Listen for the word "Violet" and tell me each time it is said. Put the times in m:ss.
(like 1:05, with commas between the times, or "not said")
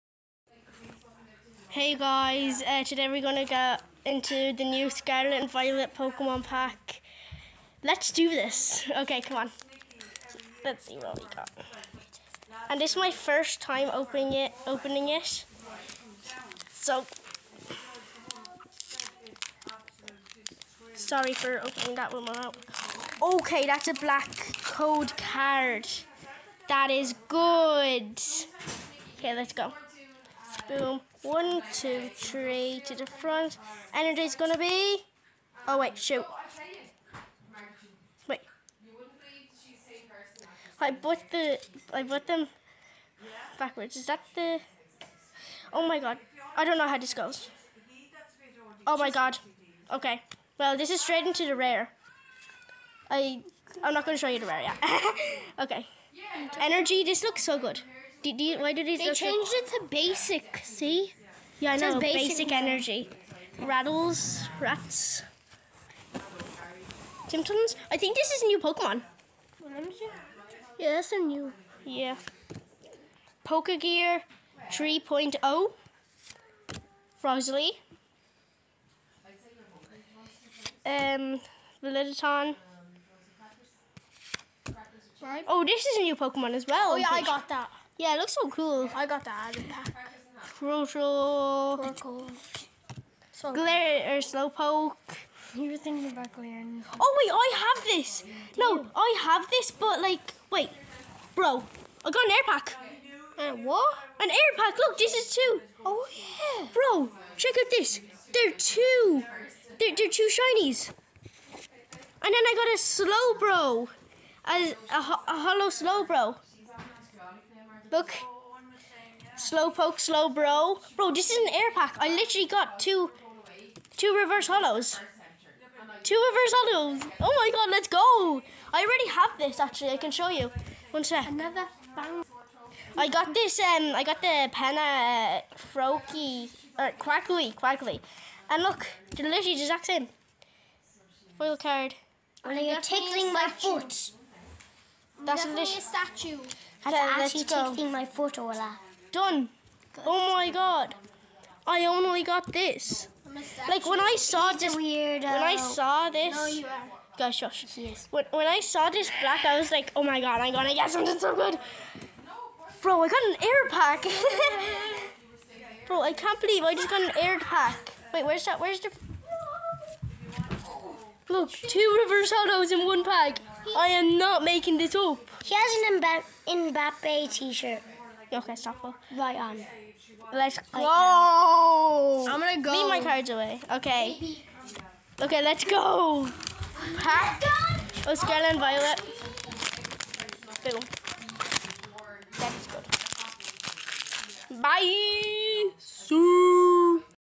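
0:05, 3:08.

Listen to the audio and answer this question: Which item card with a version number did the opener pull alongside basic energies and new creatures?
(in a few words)
Pokegear 3.0.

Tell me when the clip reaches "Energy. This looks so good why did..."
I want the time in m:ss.
0:56.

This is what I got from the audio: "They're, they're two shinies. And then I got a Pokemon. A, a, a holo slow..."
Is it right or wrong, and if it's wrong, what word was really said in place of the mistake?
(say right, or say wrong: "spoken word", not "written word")
wrong: "Slowbro", not "Pokemon".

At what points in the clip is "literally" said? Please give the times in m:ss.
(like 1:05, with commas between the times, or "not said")
2:02, 2:19.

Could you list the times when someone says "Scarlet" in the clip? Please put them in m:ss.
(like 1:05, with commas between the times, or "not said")
0:04, 3:08.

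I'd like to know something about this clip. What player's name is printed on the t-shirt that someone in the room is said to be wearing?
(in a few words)
Mbappe.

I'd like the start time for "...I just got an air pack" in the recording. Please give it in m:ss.
2:46.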